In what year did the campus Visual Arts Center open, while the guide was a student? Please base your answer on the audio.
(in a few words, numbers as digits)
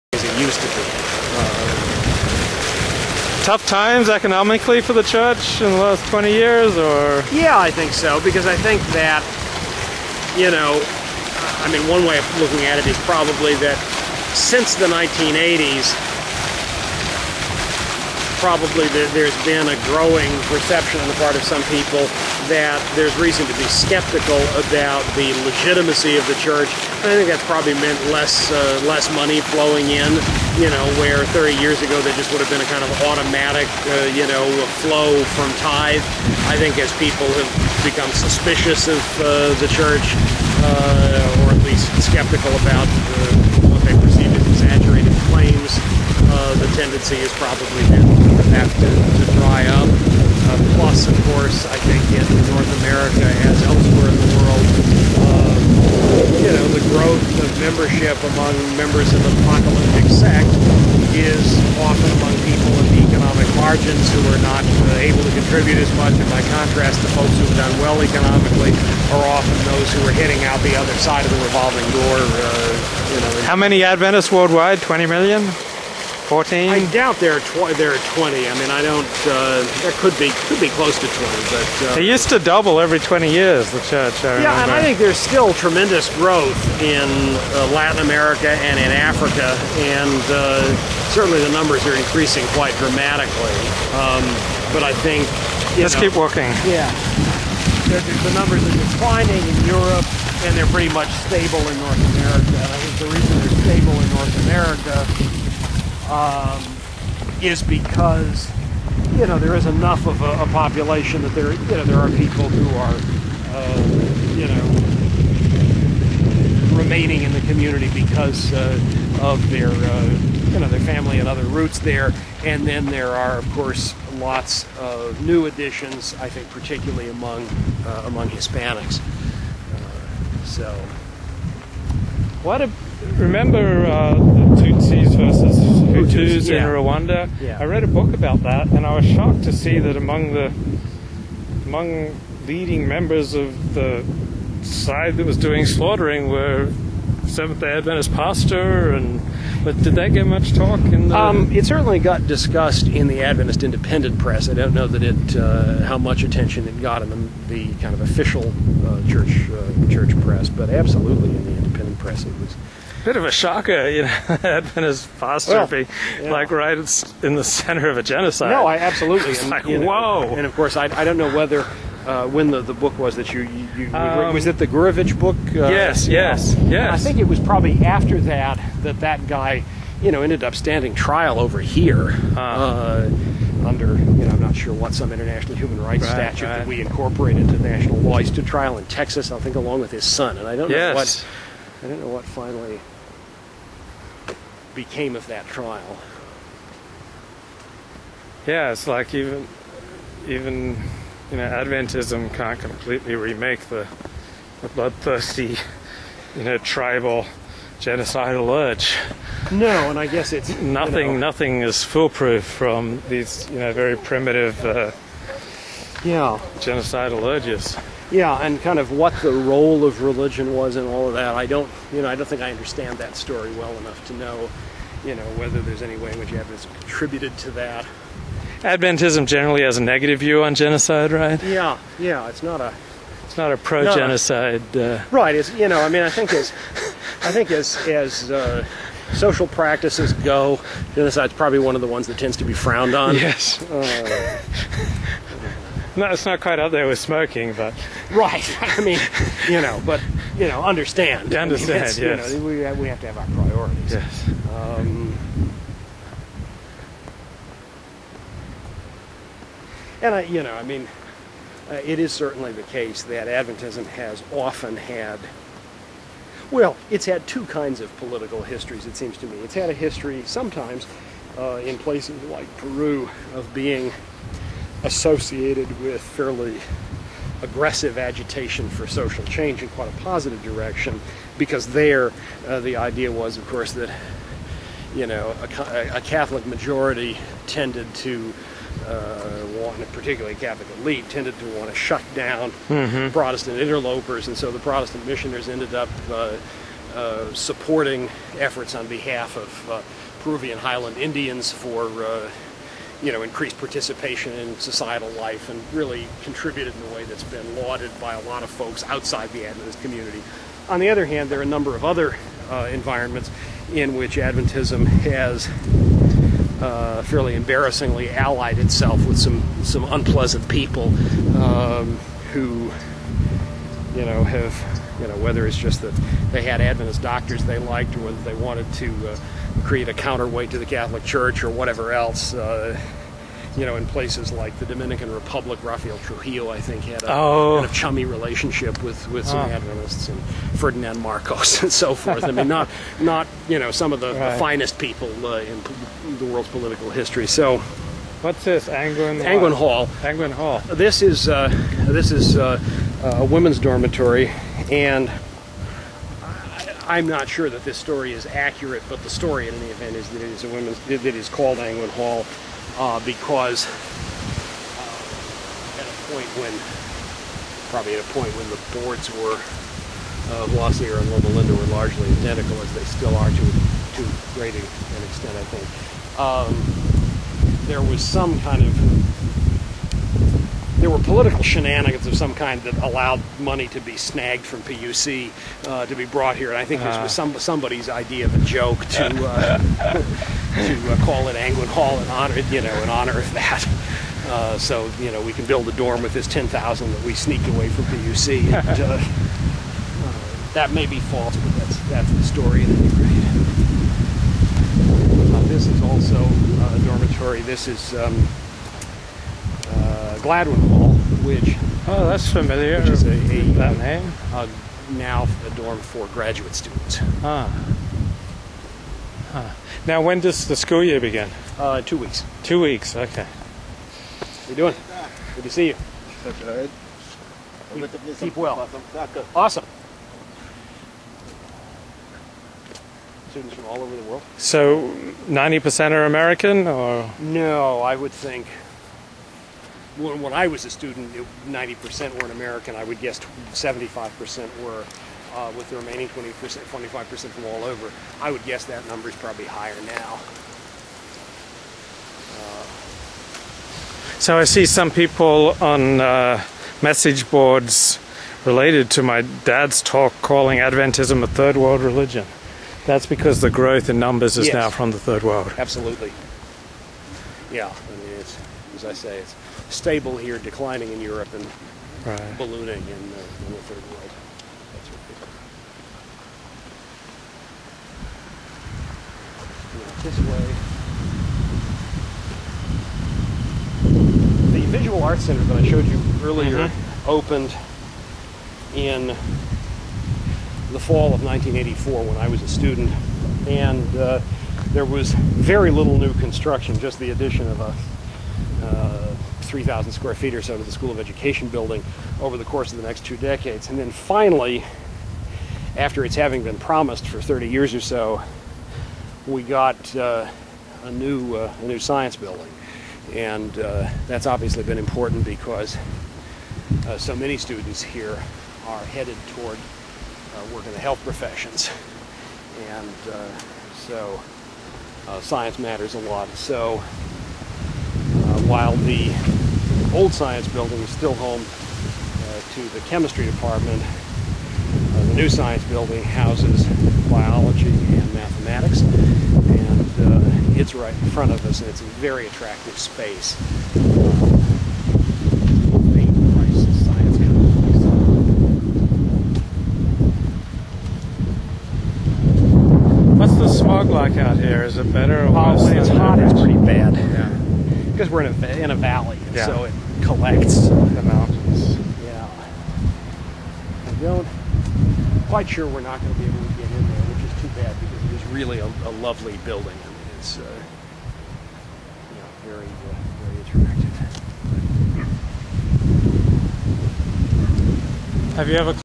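1984.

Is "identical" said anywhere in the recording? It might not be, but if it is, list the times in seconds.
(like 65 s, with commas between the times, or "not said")
372 s.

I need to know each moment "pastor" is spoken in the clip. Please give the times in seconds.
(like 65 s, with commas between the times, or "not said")
148 s, 165 s.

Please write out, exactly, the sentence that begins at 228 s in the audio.
Adventism generally has a negative view on genocide, right?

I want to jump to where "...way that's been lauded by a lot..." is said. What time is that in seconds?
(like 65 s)
306 s.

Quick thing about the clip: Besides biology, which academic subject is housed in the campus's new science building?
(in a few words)
mathematics.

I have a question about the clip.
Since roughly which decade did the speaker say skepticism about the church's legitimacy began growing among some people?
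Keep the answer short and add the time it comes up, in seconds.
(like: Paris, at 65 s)
1980s, at 14 s.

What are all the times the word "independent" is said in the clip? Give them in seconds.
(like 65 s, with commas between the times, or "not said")
153 s, 161 s.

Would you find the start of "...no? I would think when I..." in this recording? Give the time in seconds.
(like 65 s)
437 s.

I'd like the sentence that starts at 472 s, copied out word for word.
ballooning in, in, the third world.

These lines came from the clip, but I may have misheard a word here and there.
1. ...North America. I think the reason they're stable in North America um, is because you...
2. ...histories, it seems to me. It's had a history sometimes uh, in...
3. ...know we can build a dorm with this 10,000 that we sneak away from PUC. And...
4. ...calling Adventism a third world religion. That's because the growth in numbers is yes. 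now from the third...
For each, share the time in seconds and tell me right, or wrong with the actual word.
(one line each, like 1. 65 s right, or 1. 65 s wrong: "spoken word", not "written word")
1. 101 s right
2. 268 s right
3. 395 s right
4. 460 s right.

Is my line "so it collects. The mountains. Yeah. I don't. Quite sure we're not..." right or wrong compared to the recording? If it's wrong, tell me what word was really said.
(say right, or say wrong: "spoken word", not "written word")
right.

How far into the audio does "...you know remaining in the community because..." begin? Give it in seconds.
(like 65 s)
114 s.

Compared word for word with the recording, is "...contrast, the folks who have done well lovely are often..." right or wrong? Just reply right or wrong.
wrong.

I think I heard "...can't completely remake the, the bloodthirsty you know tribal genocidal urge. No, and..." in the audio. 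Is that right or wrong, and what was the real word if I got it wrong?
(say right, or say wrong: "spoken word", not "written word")
right.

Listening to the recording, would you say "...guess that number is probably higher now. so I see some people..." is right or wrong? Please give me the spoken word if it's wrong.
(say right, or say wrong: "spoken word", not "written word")
right.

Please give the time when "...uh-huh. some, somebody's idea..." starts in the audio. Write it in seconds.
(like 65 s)
387 s.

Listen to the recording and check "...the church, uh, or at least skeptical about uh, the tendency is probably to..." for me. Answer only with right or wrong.
right.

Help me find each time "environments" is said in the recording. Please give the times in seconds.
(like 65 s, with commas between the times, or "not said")
312 s.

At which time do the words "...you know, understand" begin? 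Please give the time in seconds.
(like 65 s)
250 s.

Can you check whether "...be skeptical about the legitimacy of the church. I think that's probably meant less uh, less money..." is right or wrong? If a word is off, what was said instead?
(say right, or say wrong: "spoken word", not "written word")
right.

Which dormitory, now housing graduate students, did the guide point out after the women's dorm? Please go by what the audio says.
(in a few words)
Gladwin Hall.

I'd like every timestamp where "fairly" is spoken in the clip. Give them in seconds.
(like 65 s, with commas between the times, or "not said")
276 s, 317 s.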